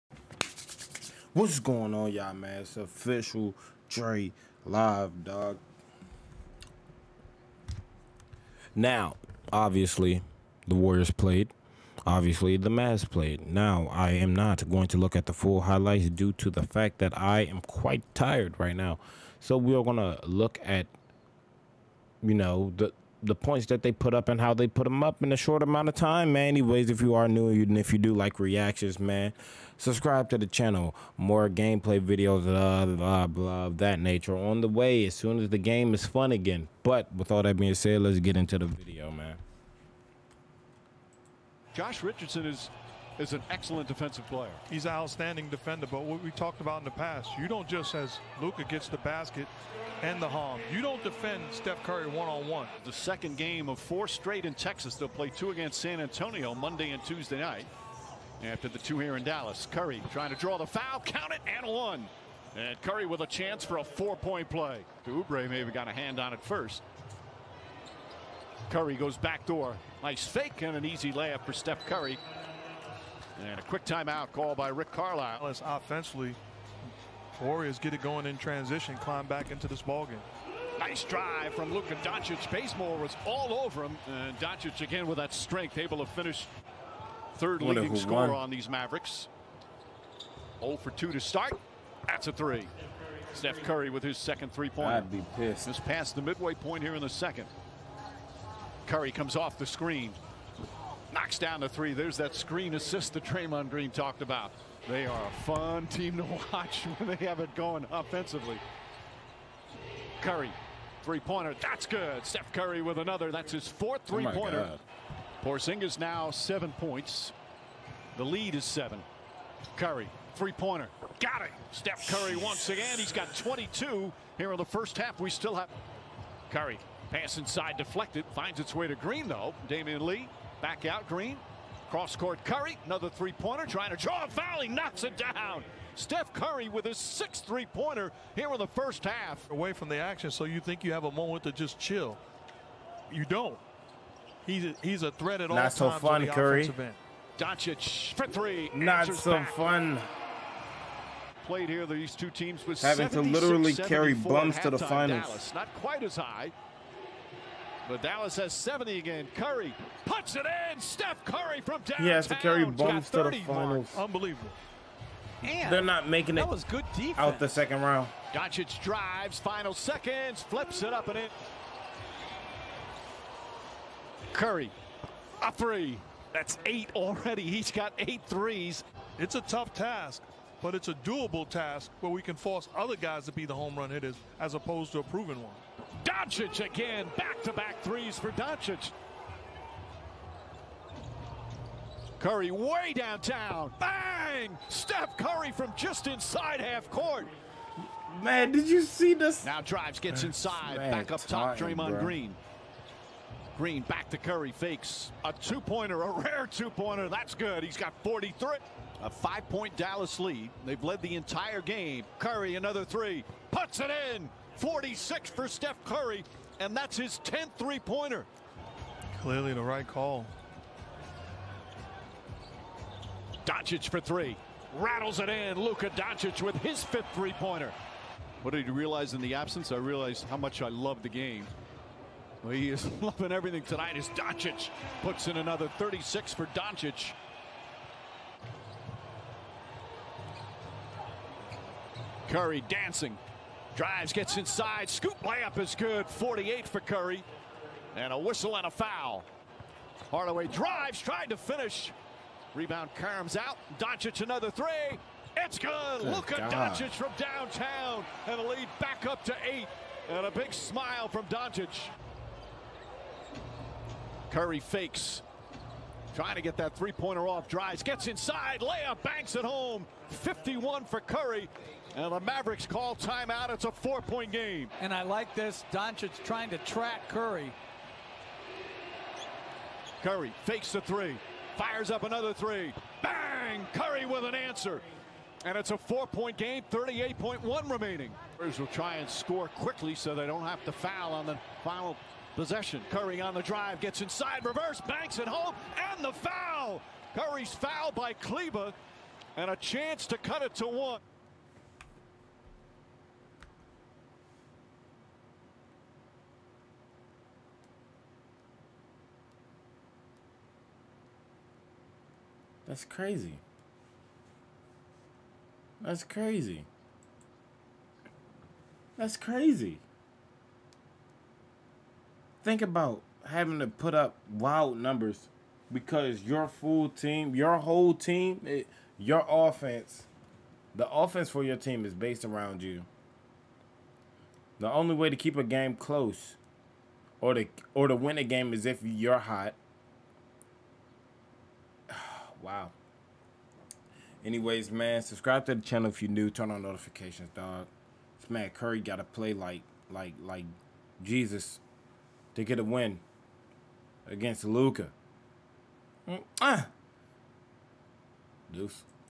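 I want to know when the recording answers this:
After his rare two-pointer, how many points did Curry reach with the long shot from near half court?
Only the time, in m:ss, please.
3:28.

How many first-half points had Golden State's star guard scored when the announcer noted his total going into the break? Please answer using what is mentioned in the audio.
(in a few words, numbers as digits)
22.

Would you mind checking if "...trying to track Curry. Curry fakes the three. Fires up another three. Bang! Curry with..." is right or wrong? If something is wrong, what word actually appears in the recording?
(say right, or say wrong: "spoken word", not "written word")
right.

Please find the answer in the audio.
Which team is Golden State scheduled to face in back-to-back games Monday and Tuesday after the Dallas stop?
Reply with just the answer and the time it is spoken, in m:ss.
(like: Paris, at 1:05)
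San Antonio, at 0:55.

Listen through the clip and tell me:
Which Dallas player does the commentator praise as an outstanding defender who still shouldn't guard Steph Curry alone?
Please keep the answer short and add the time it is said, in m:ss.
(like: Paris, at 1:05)
Josh Richardson, at 0:41.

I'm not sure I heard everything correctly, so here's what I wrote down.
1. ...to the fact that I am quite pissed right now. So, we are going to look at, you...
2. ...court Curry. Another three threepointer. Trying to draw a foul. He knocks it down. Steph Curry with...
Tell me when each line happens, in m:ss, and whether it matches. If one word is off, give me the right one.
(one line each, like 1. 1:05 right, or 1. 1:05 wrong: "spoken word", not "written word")
1. 0:16 wrong: "tired", not "pissed"
2. 2:12 wrong: "pointer", not "threepointer".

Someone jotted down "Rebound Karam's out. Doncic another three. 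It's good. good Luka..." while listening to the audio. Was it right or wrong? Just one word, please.
right.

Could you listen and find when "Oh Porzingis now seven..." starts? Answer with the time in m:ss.
1:54.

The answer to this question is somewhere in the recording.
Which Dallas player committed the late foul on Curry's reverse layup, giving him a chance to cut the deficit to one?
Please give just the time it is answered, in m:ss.
4:58.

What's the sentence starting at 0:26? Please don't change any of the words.
Anyways, if you are new and if you do like reactions, man, subscribe to the channel.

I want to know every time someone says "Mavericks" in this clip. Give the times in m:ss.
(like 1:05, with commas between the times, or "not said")
1:28, 4:32.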